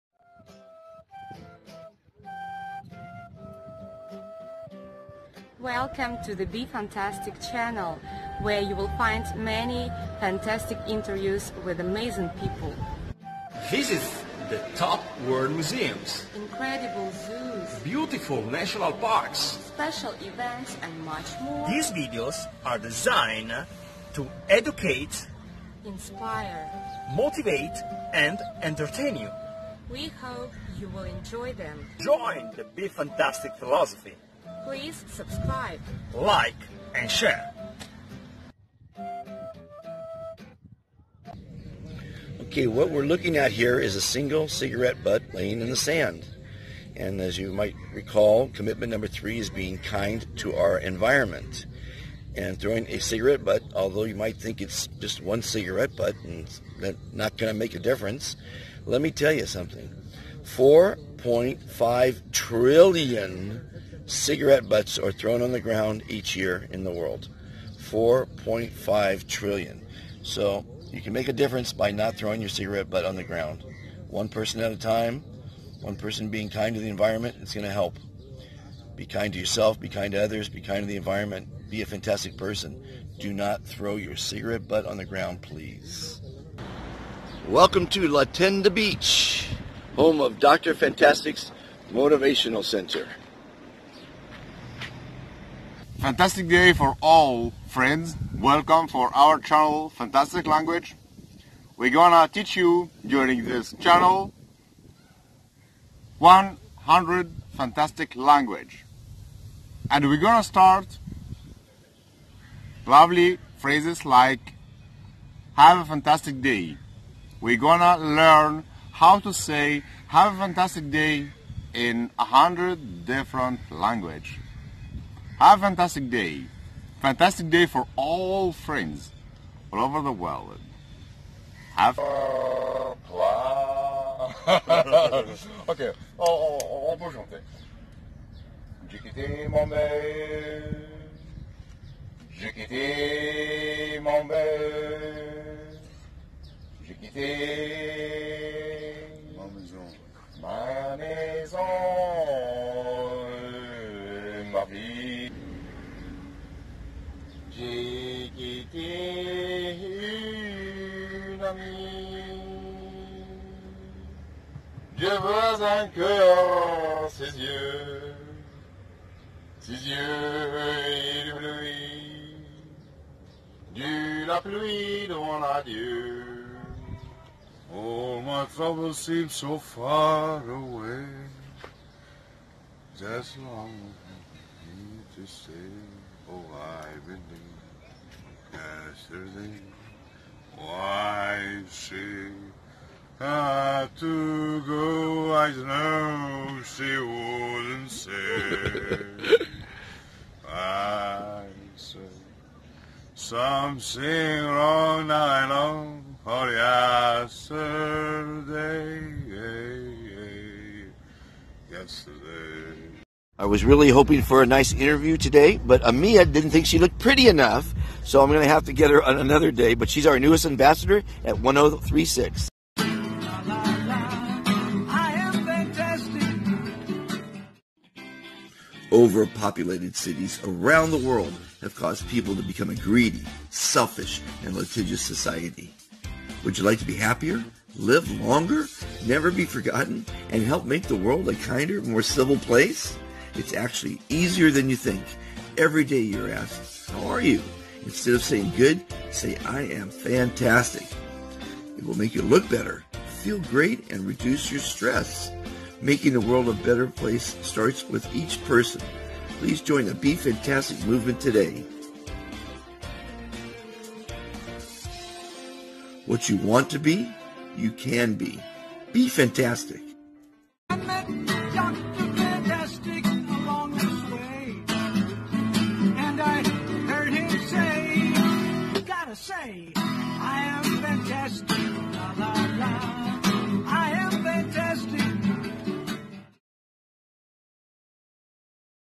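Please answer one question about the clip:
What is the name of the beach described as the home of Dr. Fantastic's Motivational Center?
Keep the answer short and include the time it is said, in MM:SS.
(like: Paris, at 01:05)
La Tenda Beach, at 01:28.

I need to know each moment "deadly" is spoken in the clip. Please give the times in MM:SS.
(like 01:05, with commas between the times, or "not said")
not said.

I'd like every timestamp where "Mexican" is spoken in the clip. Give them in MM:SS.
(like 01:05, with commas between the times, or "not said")
not said.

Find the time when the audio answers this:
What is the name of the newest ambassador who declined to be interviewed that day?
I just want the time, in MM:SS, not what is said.
03:35.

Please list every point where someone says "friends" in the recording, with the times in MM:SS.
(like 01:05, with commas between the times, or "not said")
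01:37, 02:08.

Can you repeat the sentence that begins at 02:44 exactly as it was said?
Dieu veut un cœur ses yeux, ses yeux pluie.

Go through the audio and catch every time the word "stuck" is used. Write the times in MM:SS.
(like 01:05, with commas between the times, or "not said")
not said.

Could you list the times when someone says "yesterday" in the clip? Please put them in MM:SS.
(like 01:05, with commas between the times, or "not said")
03:08, 03:26, 03:31.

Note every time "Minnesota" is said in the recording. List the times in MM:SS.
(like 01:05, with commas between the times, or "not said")
not said.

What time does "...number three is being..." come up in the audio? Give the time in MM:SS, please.
00:48.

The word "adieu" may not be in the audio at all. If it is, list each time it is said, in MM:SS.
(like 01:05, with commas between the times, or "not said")
02:55.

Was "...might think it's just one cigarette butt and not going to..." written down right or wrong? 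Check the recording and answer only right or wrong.
right.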